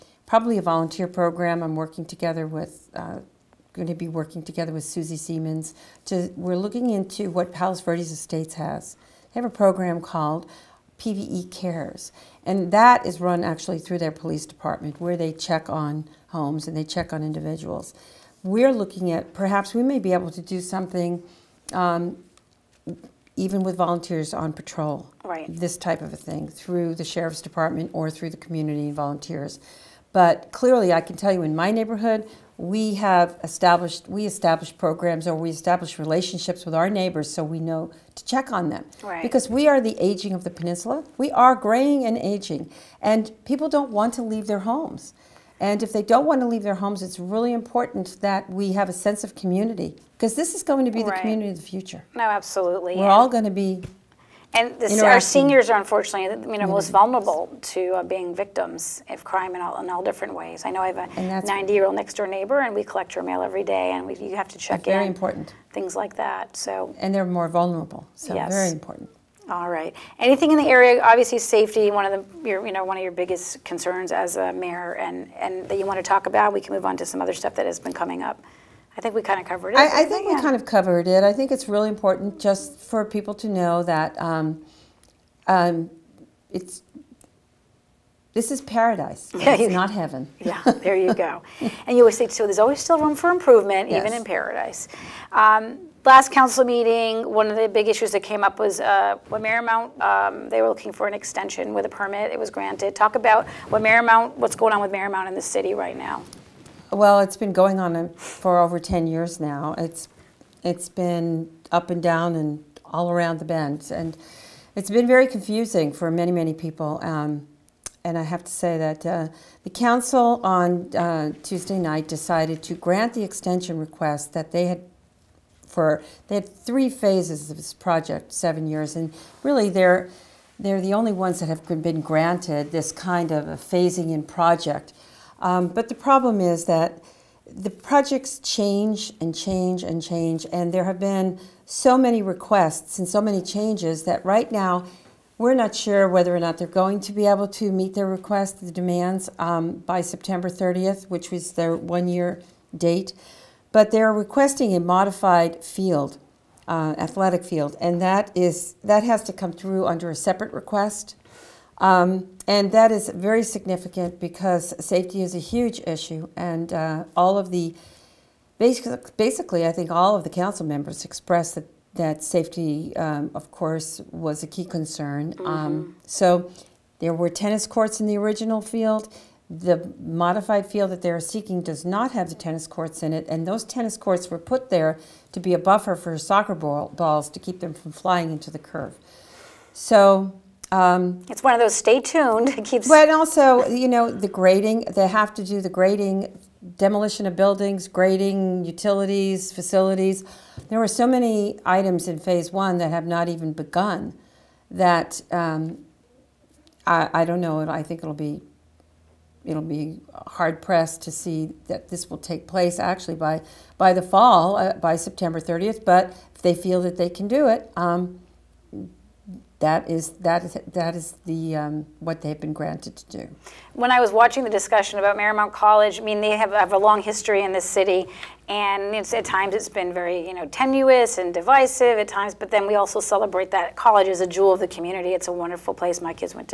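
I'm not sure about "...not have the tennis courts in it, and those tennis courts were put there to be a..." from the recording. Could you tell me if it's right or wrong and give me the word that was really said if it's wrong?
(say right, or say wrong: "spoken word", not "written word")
right.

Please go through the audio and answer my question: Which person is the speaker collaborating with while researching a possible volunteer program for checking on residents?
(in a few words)
Susie Seamans.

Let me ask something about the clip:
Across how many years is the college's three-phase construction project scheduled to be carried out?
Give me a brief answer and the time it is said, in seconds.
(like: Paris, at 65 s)
7, at 128 s.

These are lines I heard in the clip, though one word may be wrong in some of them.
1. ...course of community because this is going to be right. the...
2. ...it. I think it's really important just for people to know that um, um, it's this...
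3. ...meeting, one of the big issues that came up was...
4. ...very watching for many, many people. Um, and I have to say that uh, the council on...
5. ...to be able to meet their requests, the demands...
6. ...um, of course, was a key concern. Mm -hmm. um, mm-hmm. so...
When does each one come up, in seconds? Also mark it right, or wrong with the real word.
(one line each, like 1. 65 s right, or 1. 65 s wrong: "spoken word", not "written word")
1. 48 s wrong: "sense", not "course"
2. 81 s right
3. 96 s right
4. 115 s wrong: "confusing", not "watching"
5. 146 s right
6. 172 s right.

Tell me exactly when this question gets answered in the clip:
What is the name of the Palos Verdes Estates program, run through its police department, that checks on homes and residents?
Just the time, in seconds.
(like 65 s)
10 s.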